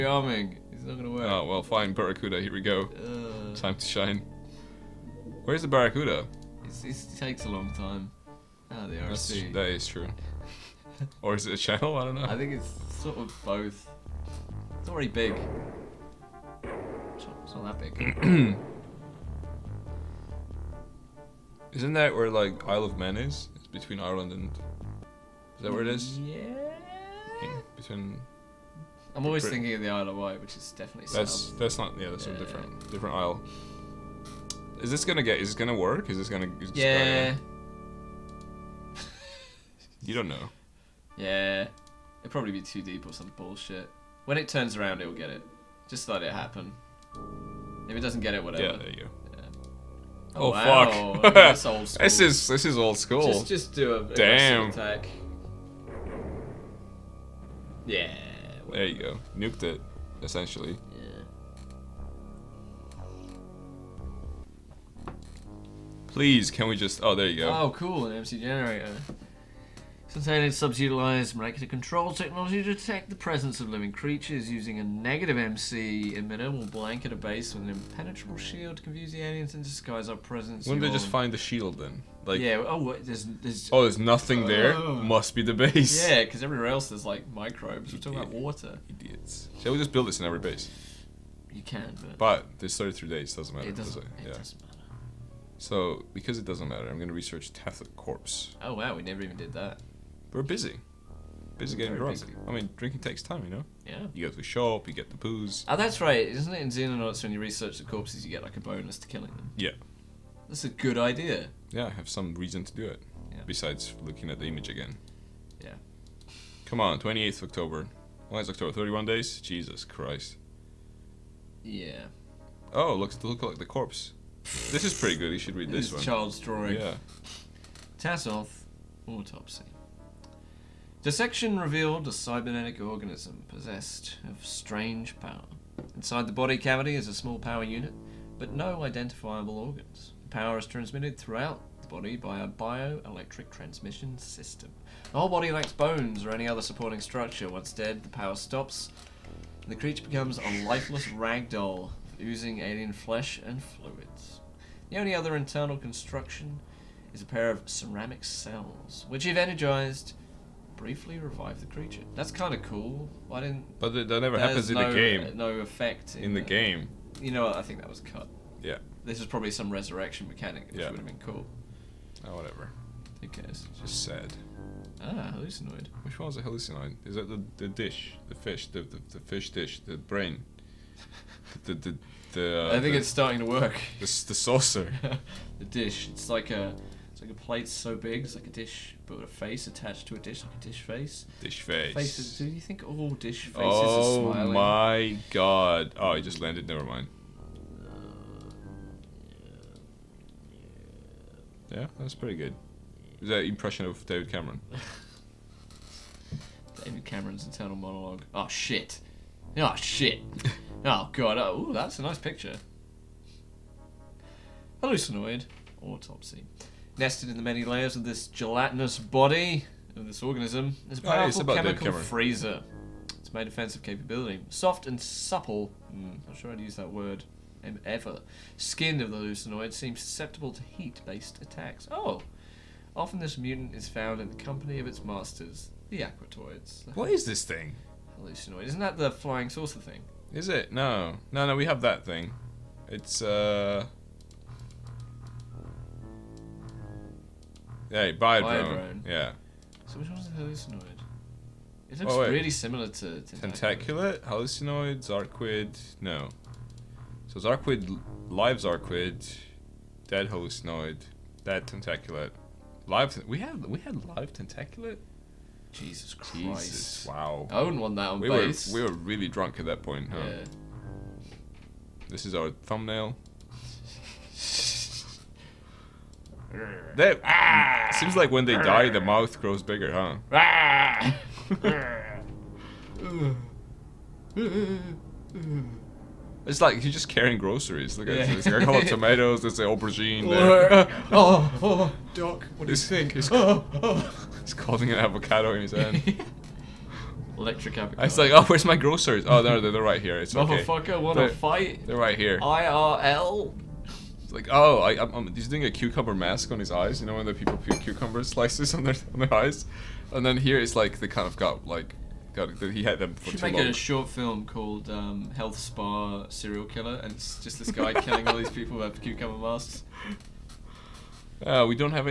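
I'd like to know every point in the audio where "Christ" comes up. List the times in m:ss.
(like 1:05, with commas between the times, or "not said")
1:59, 4:26.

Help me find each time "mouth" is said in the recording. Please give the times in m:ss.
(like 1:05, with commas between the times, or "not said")
4:38.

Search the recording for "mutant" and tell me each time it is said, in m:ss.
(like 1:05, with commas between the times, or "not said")
3:53.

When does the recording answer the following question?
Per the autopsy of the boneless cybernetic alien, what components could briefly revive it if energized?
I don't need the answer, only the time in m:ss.
2:37.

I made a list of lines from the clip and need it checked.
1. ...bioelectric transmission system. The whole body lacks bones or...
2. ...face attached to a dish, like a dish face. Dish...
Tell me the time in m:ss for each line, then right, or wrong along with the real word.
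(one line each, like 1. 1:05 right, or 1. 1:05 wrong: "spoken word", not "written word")
1. 2:22 right
2. 3:09 right.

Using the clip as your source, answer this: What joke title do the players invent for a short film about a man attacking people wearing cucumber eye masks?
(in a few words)
Health Spa Serial Killer.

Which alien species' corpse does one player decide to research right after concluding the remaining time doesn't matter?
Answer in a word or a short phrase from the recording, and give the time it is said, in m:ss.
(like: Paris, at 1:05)
Tasoth, at 1:37.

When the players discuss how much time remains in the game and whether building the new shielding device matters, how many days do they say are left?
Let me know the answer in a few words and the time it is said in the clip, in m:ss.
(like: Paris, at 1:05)
33, at 1:32.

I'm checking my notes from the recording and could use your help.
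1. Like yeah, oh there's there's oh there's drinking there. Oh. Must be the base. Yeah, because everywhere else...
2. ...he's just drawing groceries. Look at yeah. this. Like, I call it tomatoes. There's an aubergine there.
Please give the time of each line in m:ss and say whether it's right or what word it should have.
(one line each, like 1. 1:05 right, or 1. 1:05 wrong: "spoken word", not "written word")
1. 1:22 wrong: "nothing", not "drinking"
2. 4:46 wrong: "carrying", not "drawing".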